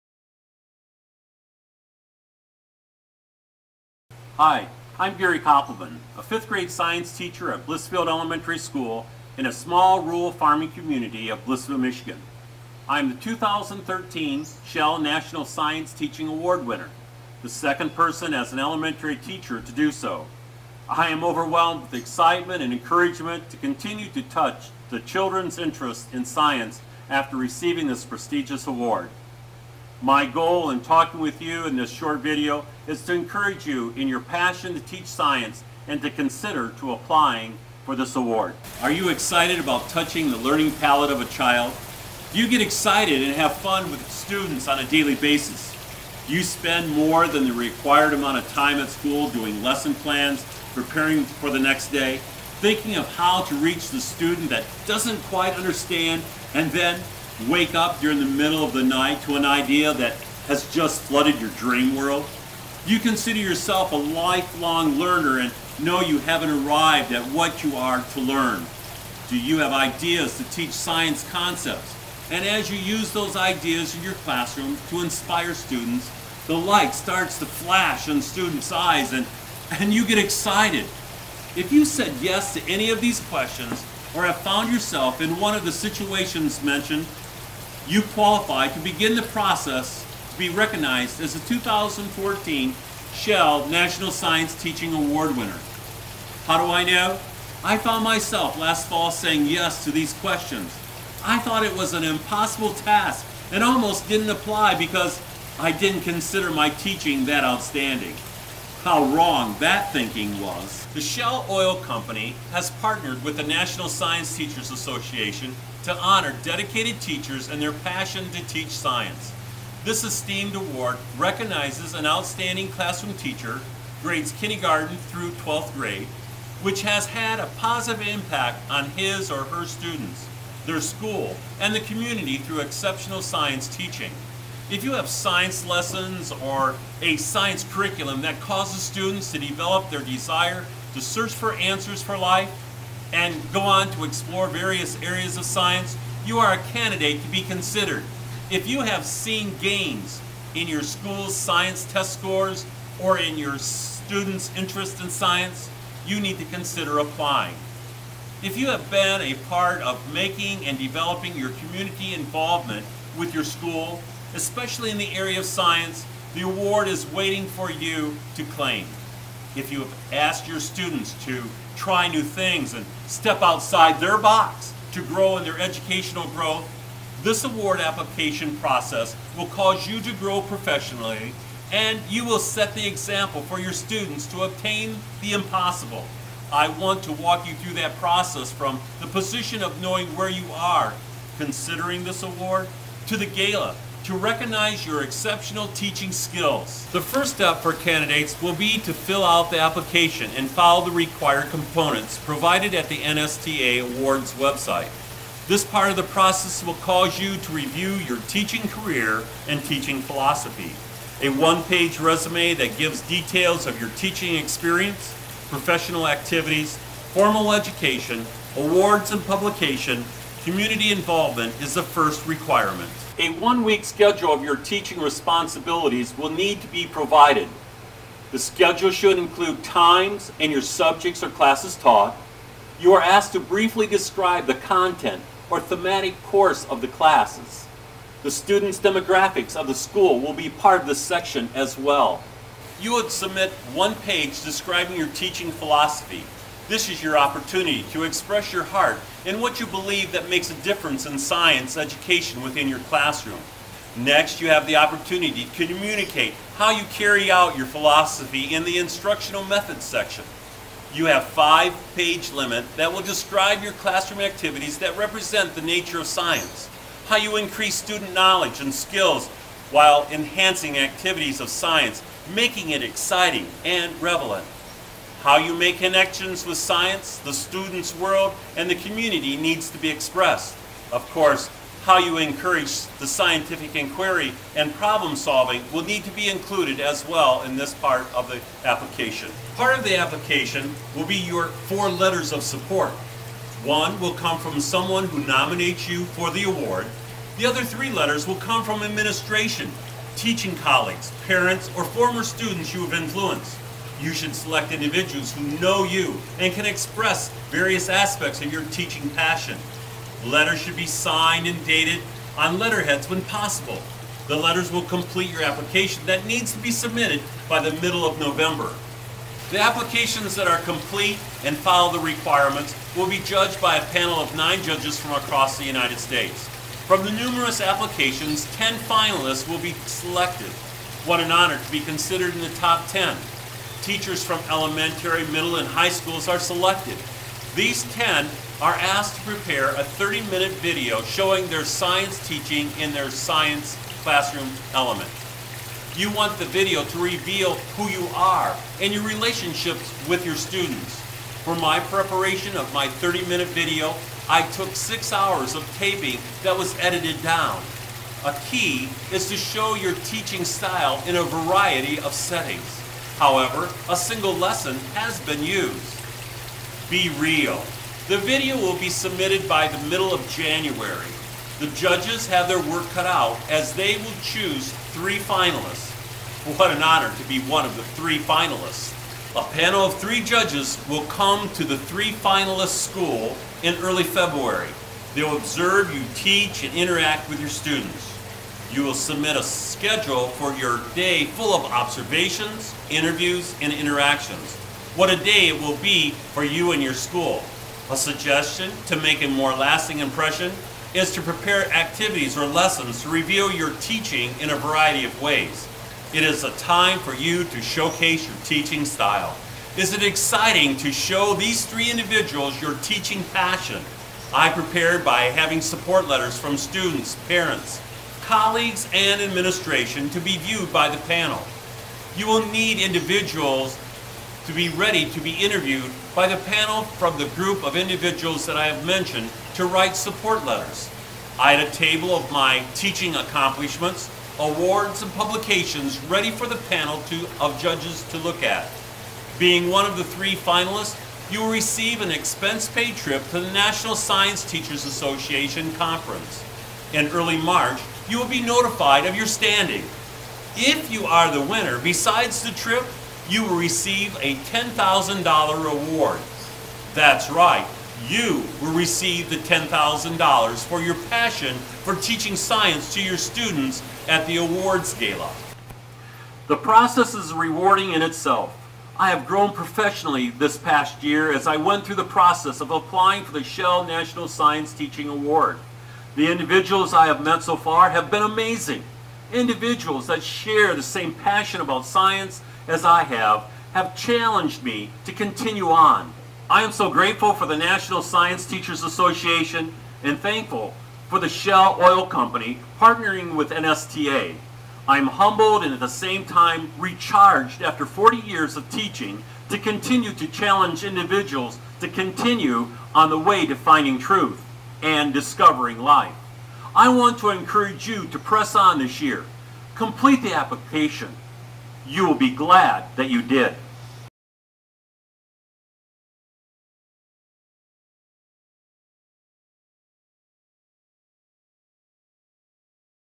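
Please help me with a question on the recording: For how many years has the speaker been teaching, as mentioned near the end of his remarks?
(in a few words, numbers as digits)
40.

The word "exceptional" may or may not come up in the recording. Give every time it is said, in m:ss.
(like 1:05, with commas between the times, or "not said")
2:12, 3:15.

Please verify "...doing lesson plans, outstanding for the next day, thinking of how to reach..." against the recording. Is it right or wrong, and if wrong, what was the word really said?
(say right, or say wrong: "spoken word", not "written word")
wrong: "preparing", not "outstanding".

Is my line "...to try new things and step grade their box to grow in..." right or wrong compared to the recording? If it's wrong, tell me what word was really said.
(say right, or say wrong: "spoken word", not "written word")
wrong: "outside", not "grade".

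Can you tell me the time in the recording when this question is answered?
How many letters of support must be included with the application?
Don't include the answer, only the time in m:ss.
4:51.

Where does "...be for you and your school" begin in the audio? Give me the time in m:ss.
6:35.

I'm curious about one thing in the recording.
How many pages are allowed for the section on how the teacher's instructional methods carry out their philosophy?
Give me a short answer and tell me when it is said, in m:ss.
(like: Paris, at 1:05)
5, at 4:21.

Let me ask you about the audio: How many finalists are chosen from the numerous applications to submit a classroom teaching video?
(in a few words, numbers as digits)
10.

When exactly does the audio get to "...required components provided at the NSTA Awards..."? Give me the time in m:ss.
3:20.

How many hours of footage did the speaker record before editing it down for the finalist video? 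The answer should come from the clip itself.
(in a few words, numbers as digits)
6.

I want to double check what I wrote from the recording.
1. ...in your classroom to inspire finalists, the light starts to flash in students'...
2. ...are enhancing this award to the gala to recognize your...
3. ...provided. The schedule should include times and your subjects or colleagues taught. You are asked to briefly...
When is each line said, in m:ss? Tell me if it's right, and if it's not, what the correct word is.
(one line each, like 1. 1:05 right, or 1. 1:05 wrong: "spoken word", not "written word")
1. 1:13 wrong: "students", not "finalists"
2. 3:10 wrong: "considering", not "enhancing"
3. 3:46 wrong: "classes", not "colleagues".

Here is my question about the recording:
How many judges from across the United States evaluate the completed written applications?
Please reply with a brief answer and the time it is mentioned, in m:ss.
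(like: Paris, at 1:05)
9, at 5:24.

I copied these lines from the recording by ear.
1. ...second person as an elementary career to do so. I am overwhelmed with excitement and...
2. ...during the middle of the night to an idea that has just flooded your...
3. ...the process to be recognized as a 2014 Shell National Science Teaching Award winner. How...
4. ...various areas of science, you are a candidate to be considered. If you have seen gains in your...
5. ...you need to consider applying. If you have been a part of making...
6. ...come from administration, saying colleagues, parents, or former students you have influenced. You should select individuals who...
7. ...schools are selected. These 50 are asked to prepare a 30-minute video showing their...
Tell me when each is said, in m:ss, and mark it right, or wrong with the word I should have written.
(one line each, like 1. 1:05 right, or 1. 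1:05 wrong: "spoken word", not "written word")
1. 0:17 wrong: "teacher", not "career"
2. 0:57 right
3. 1:29 right
4. 2:24 right
5. 2:36 right
6. 4:58 wrong: "teaching", not "saying"
7. 5:35 wrong: "10", not "50".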